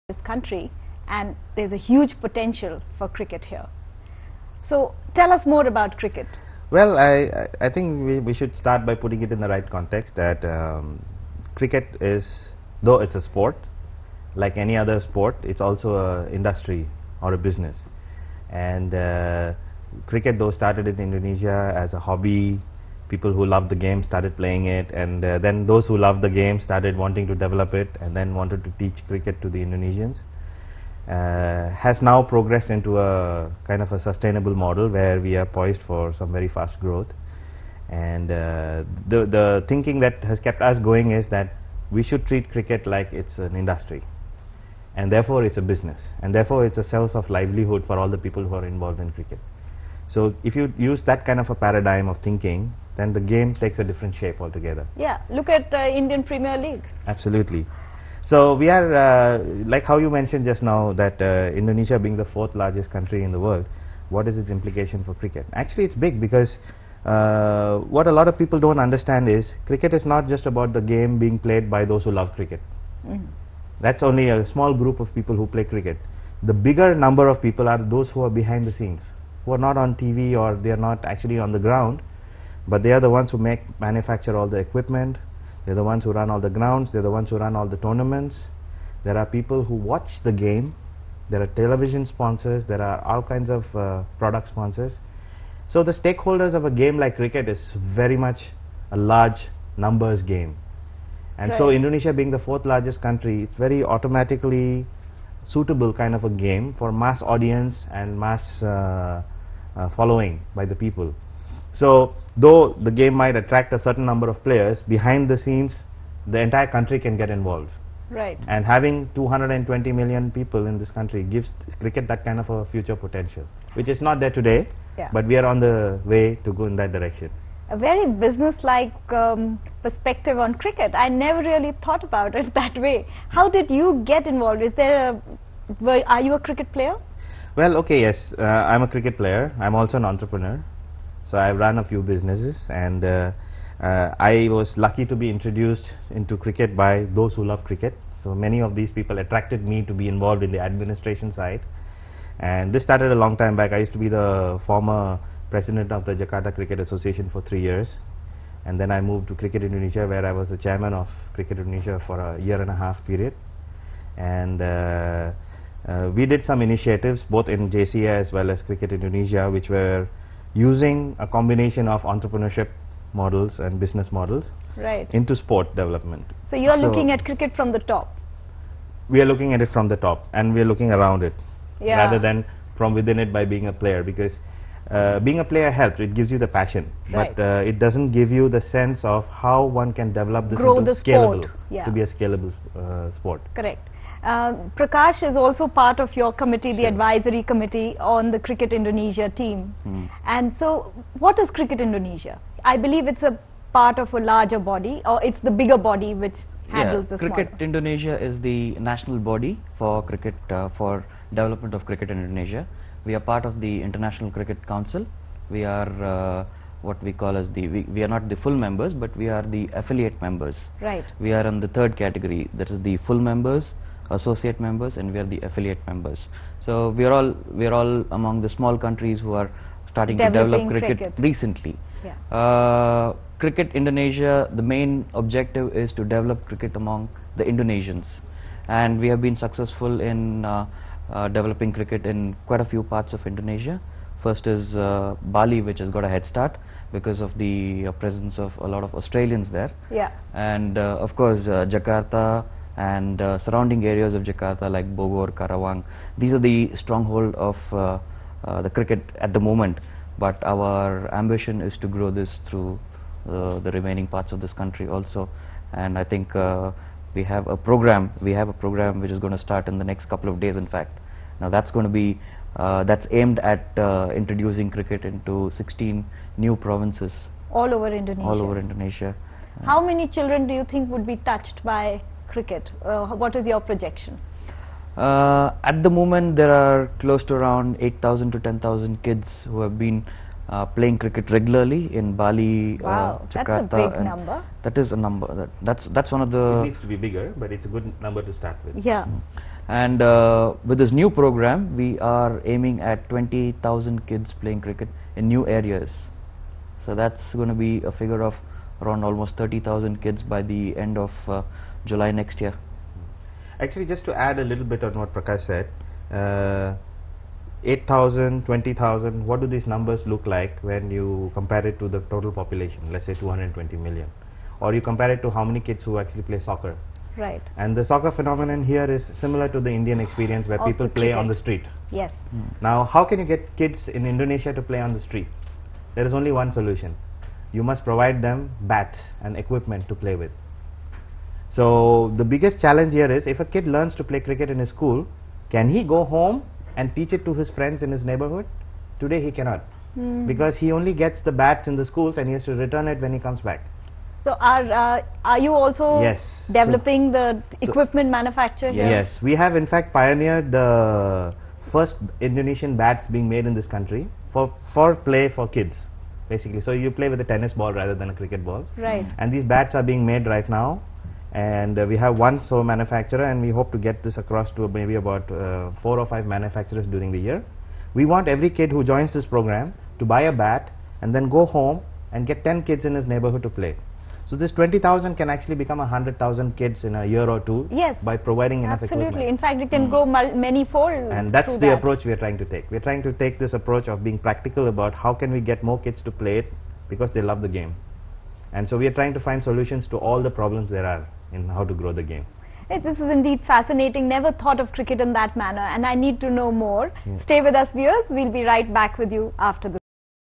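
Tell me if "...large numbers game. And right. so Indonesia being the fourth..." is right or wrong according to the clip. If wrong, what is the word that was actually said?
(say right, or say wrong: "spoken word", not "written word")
right.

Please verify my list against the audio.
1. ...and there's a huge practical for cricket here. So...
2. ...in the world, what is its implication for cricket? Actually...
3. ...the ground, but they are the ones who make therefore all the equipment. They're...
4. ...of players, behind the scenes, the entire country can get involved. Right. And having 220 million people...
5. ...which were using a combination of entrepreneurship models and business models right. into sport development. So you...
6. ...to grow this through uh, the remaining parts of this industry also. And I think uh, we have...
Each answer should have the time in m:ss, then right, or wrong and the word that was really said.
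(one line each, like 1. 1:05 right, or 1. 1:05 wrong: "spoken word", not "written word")
1. 0:01 wrong: "potential", not "practical"
2. 1:03 right
3. 1:21 wrong: "manufacture", not "therefore"
4. 1:54 right
5. 2:49 right
6. 4:21 wrong: "country", not "industry".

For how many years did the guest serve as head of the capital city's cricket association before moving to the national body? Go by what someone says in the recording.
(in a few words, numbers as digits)
3.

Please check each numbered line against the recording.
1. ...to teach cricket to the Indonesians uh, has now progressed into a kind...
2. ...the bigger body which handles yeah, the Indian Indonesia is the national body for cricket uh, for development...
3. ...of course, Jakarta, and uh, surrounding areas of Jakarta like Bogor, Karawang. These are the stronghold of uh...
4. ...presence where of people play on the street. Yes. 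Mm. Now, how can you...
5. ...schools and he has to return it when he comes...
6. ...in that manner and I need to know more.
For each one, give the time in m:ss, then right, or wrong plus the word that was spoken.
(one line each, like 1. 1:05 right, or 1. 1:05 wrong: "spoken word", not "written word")
1. 0:28 right
2. 3:25 wrong: "Cricket", not "Indian"
3. 4:11 right
4. 5:29 wrong: "experience", not "presence"
5. 5:51 right
6. 6:45 right.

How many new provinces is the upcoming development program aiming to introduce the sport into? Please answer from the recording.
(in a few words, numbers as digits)
16.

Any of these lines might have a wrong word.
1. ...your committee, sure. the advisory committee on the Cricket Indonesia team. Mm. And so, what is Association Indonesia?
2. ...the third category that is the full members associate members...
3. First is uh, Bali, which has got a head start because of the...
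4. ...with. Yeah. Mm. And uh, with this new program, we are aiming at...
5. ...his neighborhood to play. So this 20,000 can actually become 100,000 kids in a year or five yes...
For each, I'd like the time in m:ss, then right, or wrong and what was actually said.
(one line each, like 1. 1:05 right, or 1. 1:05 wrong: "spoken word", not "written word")
1. 3:16 wrong: "Cricket", not "Association"
2. 3:41 right
3. 4:04 right
4. 4:58 right
5. 6:22 wrong: "two", not "five".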